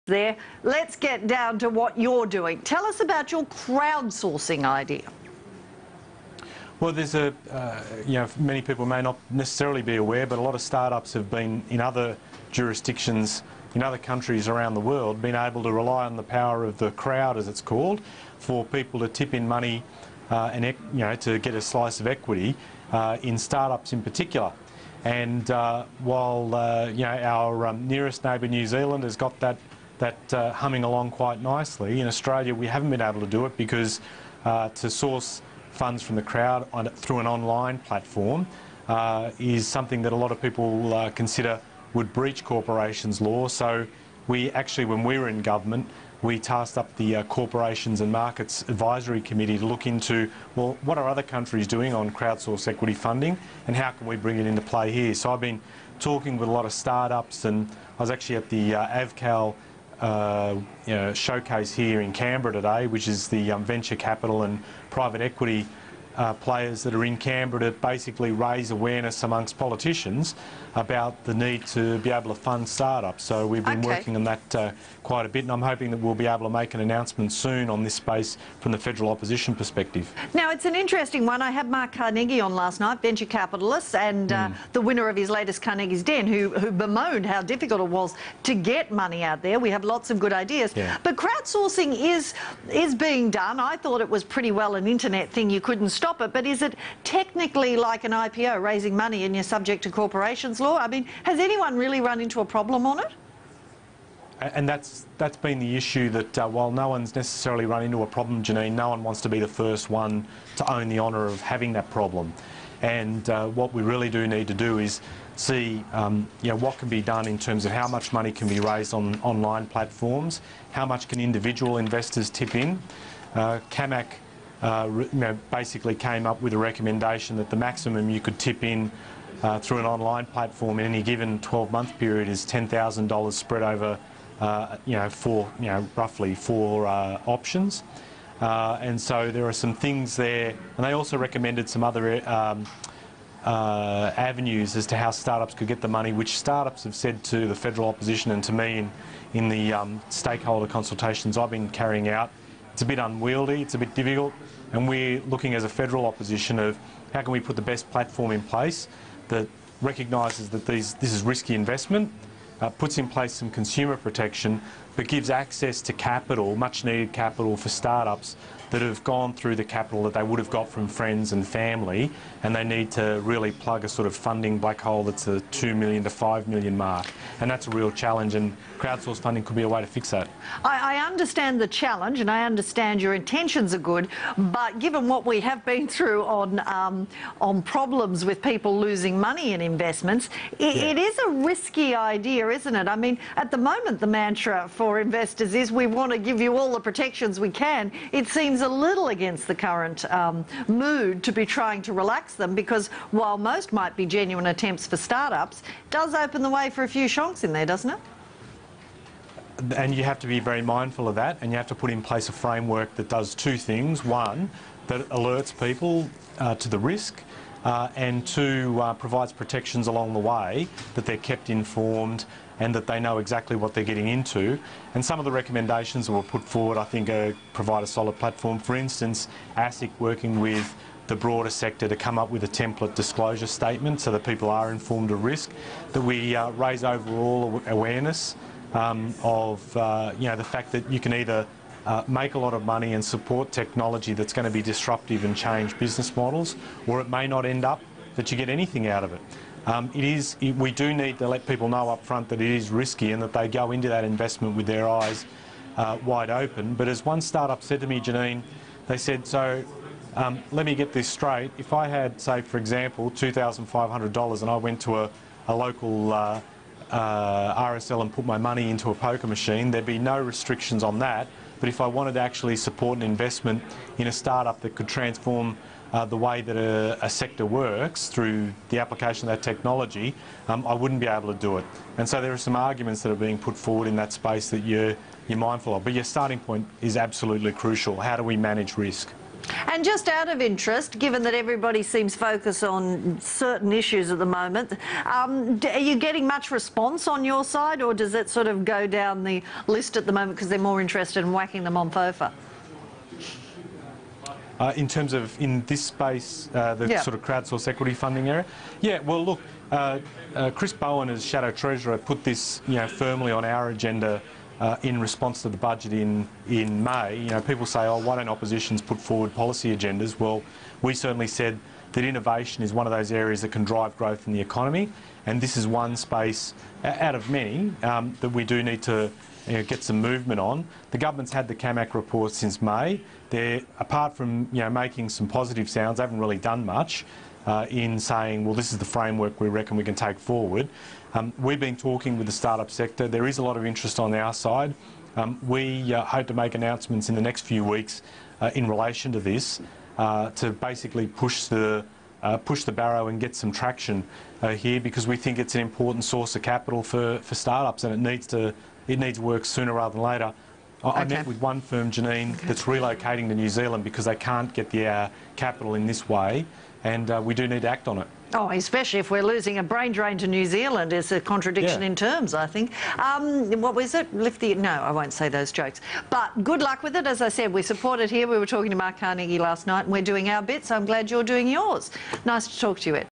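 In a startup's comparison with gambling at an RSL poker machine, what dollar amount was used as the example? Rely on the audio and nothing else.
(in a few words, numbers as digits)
$2,500.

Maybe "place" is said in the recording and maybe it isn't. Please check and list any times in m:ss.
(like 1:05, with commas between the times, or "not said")
2:38, 2:43, 3:32.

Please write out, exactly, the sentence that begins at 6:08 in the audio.
Oh, especially if we're losing a brain drain to New Zealand.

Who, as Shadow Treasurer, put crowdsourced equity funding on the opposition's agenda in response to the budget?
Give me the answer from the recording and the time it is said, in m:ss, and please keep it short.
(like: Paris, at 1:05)
Chris Bowen, at 5:10.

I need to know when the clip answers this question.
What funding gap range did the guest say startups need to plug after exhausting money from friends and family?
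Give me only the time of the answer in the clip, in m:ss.
2:55.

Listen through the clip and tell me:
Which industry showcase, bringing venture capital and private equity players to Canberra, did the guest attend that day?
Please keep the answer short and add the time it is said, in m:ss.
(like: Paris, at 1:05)
AVCAL, at 0:58.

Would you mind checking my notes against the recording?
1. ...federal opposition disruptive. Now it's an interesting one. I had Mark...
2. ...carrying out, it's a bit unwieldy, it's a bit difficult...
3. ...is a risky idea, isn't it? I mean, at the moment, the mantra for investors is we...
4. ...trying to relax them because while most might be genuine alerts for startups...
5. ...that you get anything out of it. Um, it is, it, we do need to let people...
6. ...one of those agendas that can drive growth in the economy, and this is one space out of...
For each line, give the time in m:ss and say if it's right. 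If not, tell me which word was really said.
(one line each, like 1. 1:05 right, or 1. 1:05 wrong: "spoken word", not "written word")
1. 1:18 wrong: "perspective", not "disruptive"
2. 2:31 right
3. 3:10 right
4. 3:21 wrong: "attempts", not "alerts"
5. 4:08 right
6. 5:22 wrong: "areas", not "agendas".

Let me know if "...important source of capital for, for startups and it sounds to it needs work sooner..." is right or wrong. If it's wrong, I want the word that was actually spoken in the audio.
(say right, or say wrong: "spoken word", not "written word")
wrong: "needs", not "sounds".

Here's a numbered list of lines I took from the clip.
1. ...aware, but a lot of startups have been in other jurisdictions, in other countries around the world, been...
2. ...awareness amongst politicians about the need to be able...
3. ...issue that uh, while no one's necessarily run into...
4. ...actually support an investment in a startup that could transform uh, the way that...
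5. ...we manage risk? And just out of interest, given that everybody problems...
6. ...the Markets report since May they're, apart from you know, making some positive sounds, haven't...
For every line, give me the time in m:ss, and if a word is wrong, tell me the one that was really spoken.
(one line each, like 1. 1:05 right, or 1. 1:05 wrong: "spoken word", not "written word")
1. 0:09 right
2. 1:08 right
3. 1:45 right
4. 4:32 right
5. 4:48 wrong: "seems", not "problems"
6. 5:31 wrong: "CAMAC", not "Markets".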